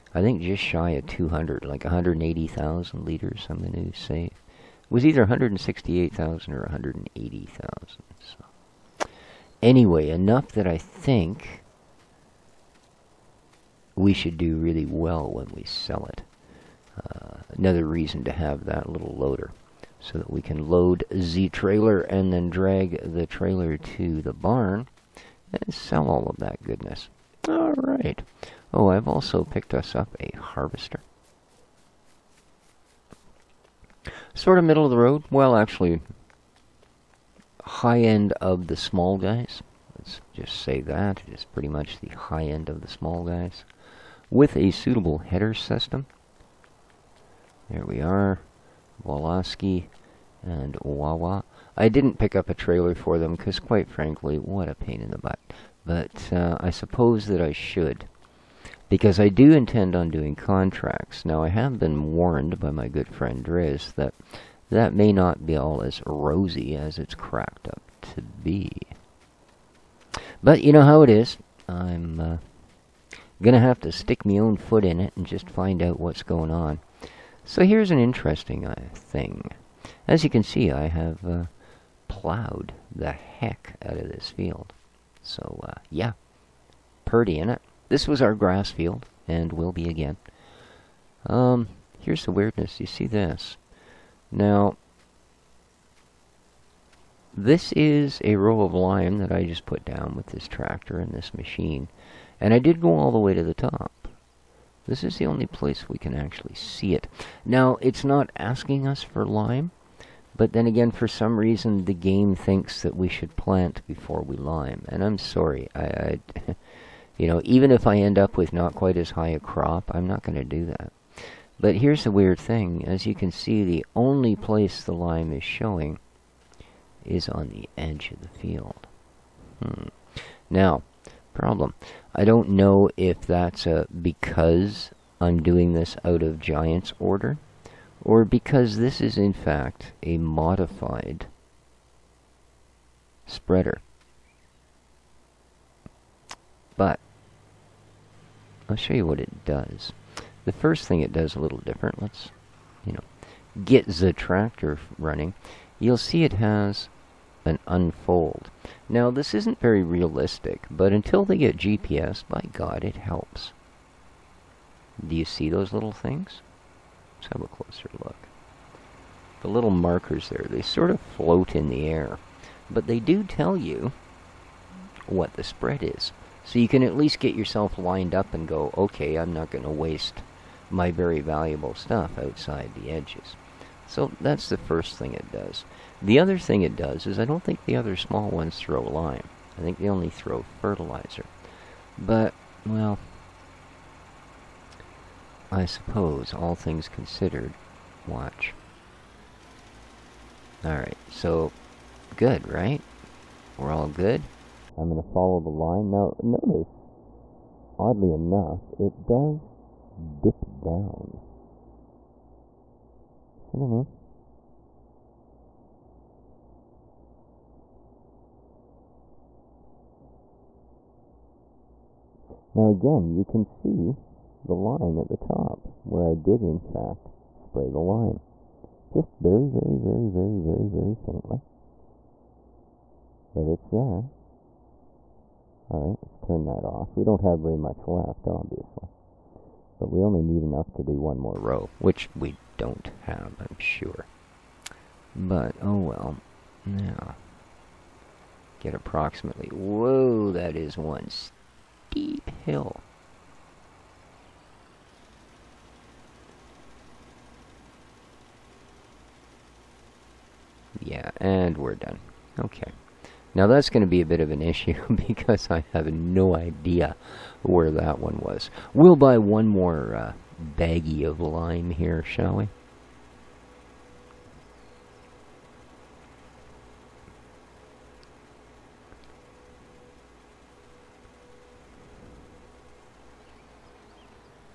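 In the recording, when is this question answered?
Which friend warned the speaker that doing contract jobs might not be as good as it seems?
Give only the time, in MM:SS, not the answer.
01:03.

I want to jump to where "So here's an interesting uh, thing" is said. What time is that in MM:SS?
01:17.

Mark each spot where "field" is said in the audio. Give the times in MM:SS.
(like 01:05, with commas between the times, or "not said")
01:24, 01:28, 02:08.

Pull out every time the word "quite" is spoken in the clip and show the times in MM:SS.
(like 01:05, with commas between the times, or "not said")
00:53, 01:58.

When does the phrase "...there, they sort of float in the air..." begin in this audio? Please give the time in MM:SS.
02:50.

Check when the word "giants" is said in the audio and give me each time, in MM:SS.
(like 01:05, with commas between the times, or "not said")
02:16.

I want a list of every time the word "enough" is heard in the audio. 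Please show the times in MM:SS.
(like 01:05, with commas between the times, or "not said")
00:10, 03:28, 04:00.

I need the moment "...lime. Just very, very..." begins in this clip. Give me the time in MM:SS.
03:47.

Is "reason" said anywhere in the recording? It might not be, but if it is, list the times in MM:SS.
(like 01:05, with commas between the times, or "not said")
00:17, 01:51.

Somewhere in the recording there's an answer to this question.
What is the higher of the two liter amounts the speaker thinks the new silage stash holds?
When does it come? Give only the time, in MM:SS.
00:01.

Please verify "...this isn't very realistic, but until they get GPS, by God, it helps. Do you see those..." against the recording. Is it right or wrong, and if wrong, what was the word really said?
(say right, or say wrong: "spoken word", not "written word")
right.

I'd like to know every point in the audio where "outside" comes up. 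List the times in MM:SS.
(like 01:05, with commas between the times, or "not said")
03:02.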